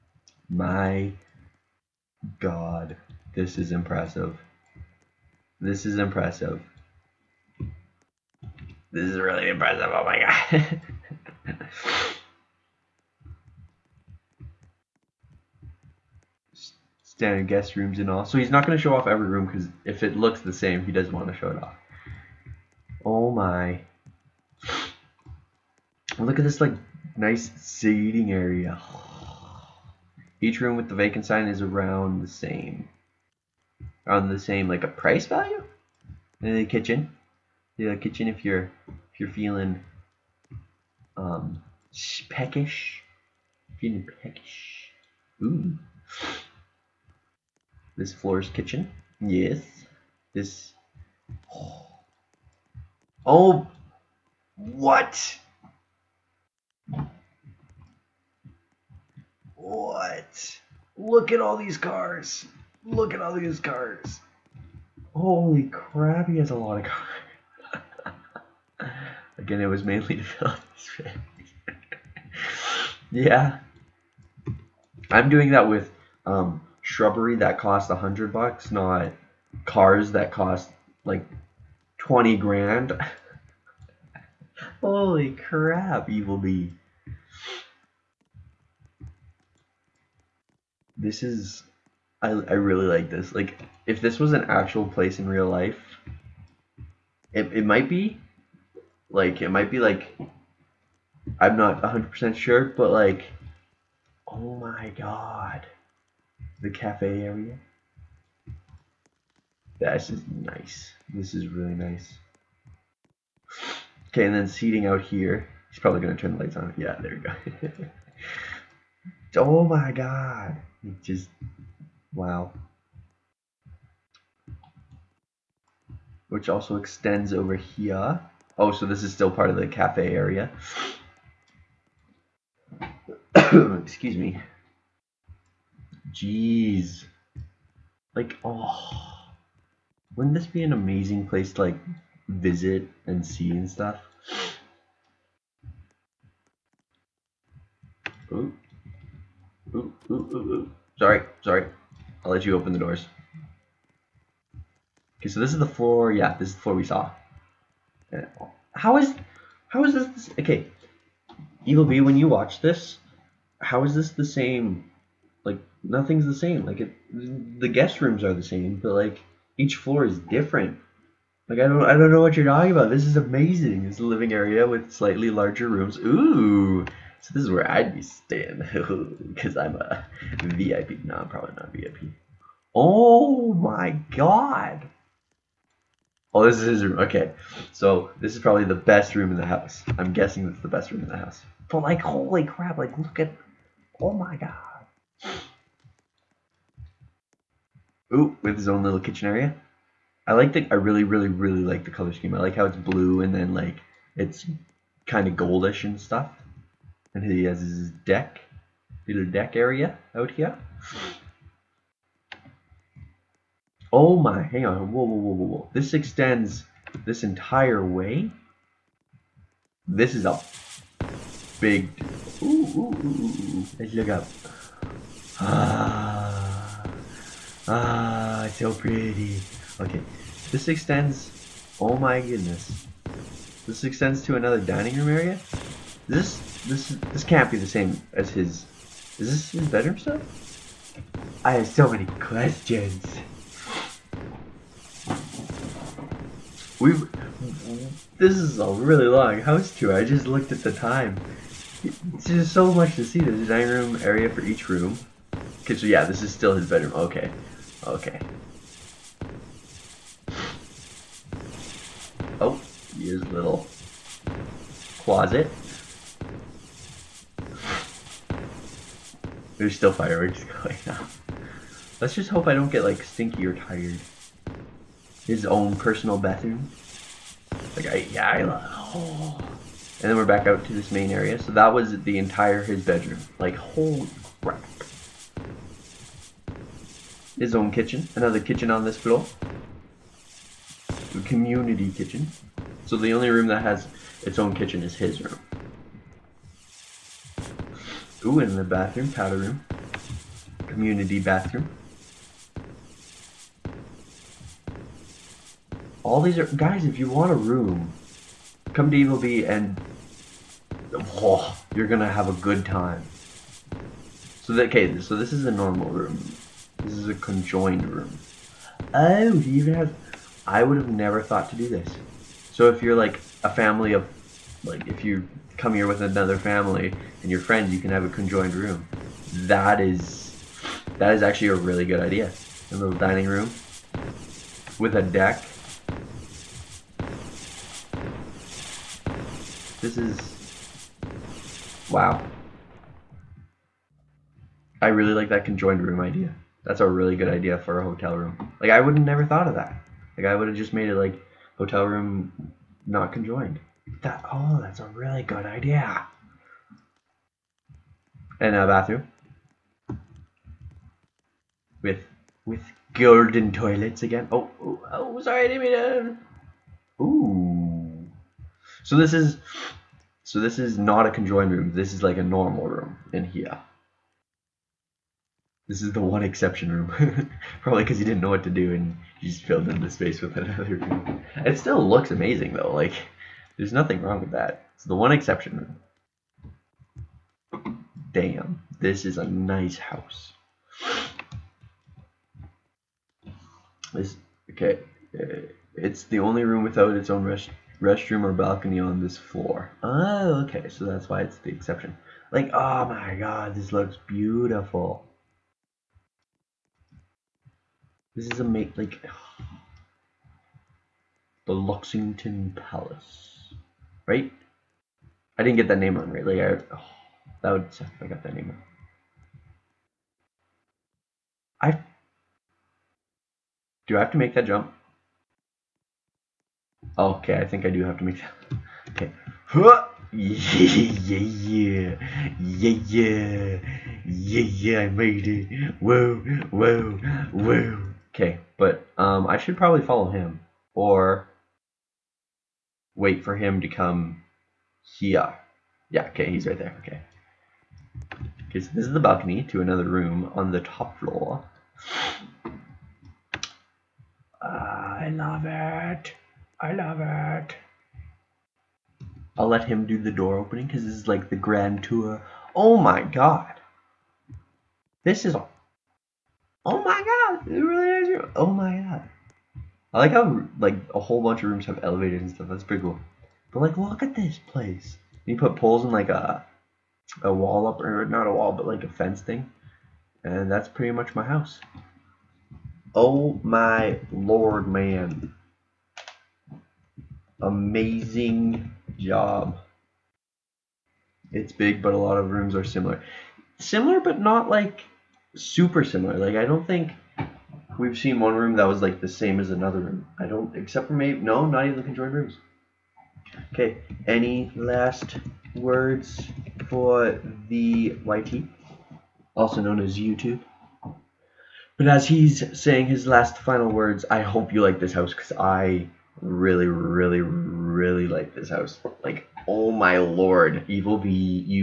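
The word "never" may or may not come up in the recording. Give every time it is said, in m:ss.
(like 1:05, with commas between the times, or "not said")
5:20, 5:49.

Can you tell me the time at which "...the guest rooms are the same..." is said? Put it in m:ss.
2:47.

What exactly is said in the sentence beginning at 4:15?
Cause yeah, this is still his bedroom, okay.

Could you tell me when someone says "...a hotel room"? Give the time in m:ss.
5:47.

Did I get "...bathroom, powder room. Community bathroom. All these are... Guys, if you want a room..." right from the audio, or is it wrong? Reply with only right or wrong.
right.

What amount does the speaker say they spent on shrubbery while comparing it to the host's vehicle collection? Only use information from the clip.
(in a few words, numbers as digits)
$100.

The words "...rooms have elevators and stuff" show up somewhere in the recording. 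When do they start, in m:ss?
7:51.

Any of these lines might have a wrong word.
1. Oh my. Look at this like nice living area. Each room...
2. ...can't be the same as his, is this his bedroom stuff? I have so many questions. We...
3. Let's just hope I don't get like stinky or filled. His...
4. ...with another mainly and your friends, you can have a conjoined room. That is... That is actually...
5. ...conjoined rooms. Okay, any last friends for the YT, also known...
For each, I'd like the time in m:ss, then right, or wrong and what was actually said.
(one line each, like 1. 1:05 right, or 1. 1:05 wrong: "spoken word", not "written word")
1. 0:23 wrong: "seating", not "living"
2. 3:57 right
3. 4:31 wrong: "tired", not "filled"
4. 5:25 wrong: "family", not "mainly"
5. 8:21 wrong: "words", not "friends".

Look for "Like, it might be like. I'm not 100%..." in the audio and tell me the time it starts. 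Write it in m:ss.
1:39.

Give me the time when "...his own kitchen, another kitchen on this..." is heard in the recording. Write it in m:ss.
4:47.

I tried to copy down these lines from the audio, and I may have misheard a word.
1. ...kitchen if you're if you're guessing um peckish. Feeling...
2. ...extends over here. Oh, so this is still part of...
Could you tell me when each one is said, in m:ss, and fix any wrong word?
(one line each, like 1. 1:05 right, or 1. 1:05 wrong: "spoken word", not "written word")
1. 0:37 wrong: "feeling", not "guessing"
2. 2:06 right.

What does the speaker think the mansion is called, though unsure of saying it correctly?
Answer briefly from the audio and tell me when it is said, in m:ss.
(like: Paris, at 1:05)
Lexington Palace, at 6:51.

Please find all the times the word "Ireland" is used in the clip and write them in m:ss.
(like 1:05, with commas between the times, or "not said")
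not said.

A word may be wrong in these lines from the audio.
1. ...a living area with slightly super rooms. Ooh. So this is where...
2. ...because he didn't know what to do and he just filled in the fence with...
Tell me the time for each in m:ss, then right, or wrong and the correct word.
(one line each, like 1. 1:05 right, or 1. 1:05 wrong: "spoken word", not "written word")
1. 2:53 wrong: "larger", not "super"
2. 6:17 wrong: "space", not "fence".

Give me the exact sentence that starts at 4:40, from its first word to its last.
And then we're back out to this main area.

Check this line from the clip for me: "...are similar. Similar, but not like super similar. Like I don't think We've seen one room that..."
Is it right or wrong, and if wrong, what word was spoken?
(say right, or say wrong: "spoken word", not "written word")
right.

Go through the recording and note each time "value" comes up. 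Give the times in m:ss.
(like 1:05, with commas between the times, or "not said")
0:35.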